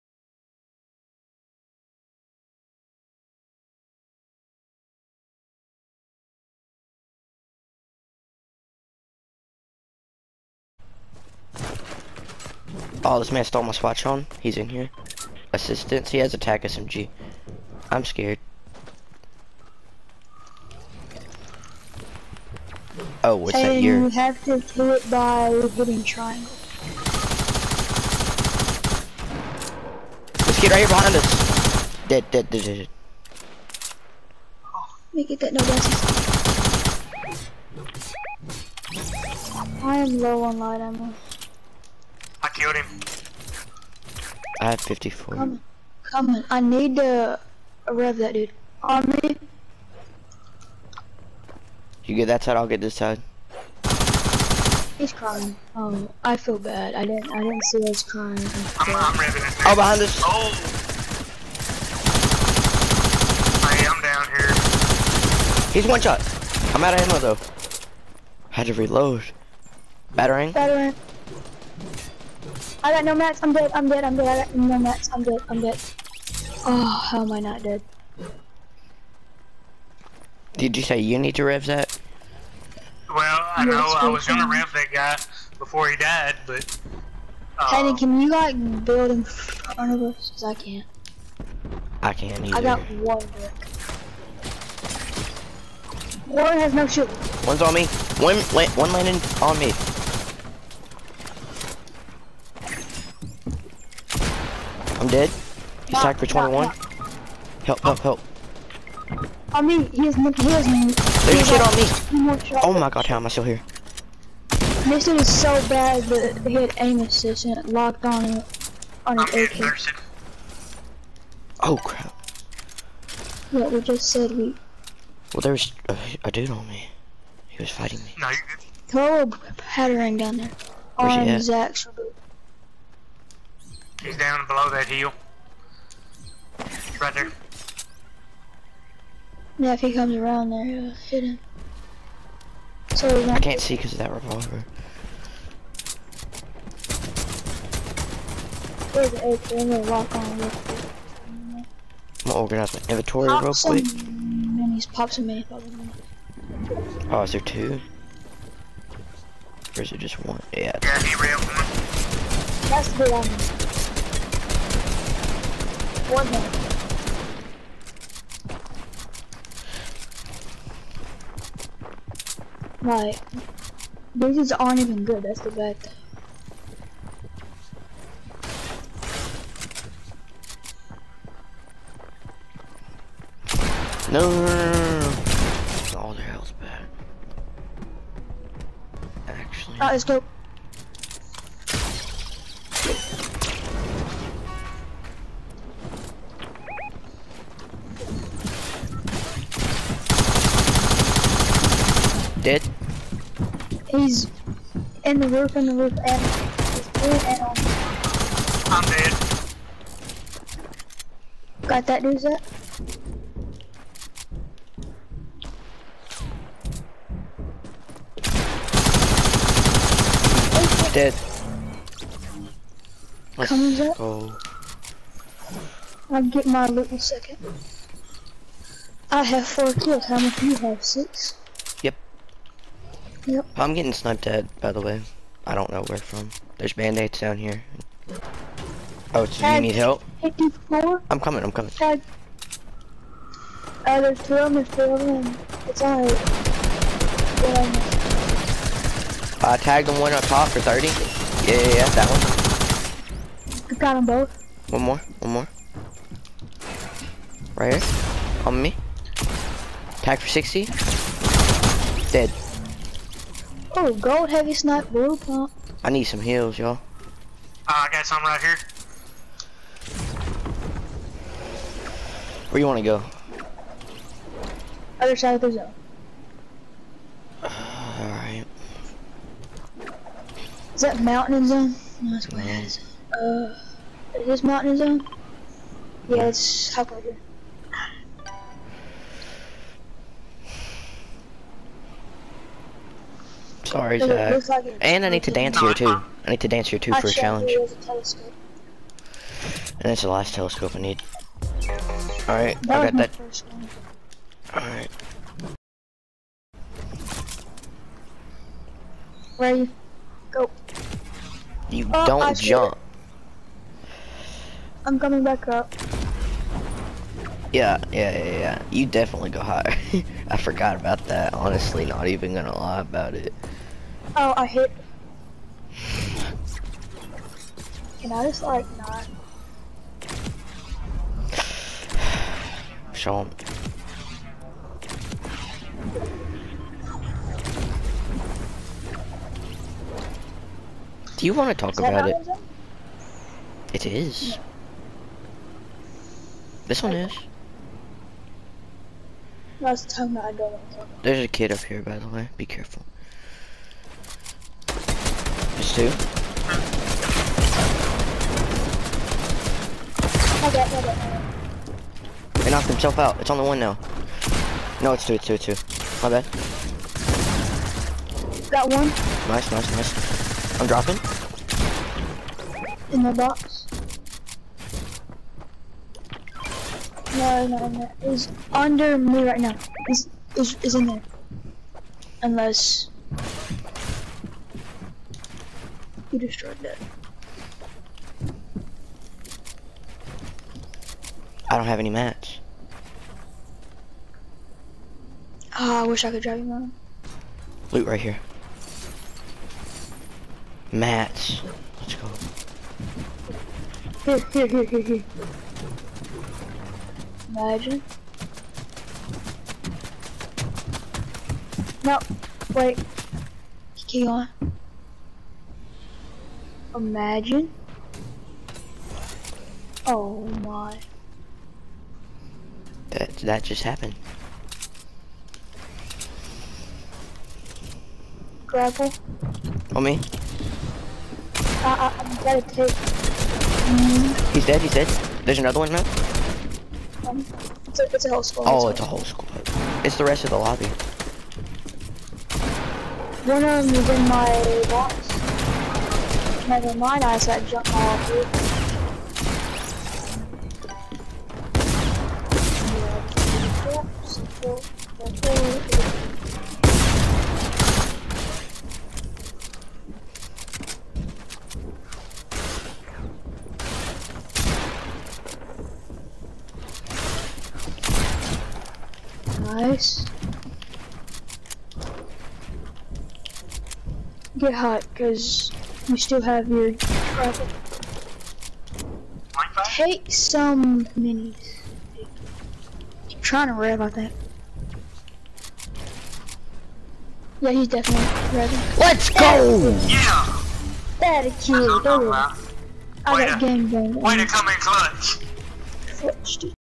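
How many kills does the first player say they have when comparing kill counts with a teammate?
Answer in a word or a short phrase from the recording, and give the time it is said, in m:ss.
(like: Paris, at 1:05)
4, at 3:49.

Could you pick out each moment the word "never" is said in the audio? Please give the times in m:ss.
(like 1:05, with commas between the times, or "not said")
7:26.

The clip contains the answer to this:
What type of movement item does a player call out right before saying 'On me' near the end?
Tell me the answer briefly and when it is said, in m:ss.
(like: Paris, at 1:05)
Grapple, at 7:08.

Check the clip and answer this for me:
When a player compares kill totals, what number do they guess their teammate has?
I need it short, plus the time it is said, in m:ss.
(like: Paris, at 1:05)
6, at 3:50.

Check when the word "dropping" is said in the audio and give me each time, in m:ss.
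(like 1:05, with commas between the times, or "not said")
6:10.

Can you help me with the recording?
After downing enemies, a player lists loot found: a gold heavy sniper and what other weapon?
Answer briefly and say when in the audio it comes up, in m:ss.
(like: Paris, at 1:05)
blue pump, at 4:24.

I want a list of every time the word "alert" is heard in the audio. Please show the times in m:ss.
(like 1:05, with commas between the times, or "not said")
not said.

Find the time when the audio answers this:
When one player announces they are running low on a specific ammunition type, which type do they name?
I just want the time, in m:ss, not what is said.
0:40.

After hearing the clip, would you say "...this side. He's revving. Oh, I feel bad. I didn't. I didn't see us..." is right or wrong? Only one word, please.
wrong.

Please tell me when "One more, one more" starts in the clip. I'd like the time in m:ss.
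4:14.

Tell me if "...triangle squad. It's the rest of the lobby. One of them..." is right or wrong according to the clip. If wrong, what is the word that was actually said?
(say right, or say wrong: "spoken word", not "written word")
wrong: "whole", not "triangle".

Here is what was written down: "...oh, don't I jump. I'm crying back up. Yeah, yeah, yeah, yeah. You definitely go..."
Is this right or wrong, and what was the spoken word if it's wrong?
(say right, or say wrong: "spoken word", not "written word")
wrong: "coming", not "crying".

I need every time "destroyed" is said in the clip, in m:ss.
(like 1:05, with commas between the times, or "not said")
6:26.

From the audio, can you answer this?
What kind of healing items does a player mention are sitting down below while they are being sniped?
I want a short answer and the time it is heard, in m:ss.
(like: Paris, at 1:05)
band-aids, at 3:56.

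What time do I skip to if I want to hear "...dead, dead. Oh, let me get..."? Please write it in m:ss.
0:32.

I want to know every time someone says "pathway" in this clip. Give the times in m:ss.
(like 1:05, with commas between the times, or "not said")
not said.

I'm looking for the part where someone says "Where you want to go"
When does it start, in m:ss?
4:32.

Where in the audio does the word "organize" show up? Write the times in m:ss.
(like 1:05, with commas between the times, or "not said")
2:32.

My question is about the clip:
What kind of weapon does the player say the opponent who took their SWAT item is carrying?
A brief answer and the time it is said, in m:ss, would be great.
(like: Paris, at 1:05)
attack SMG, at 0:16.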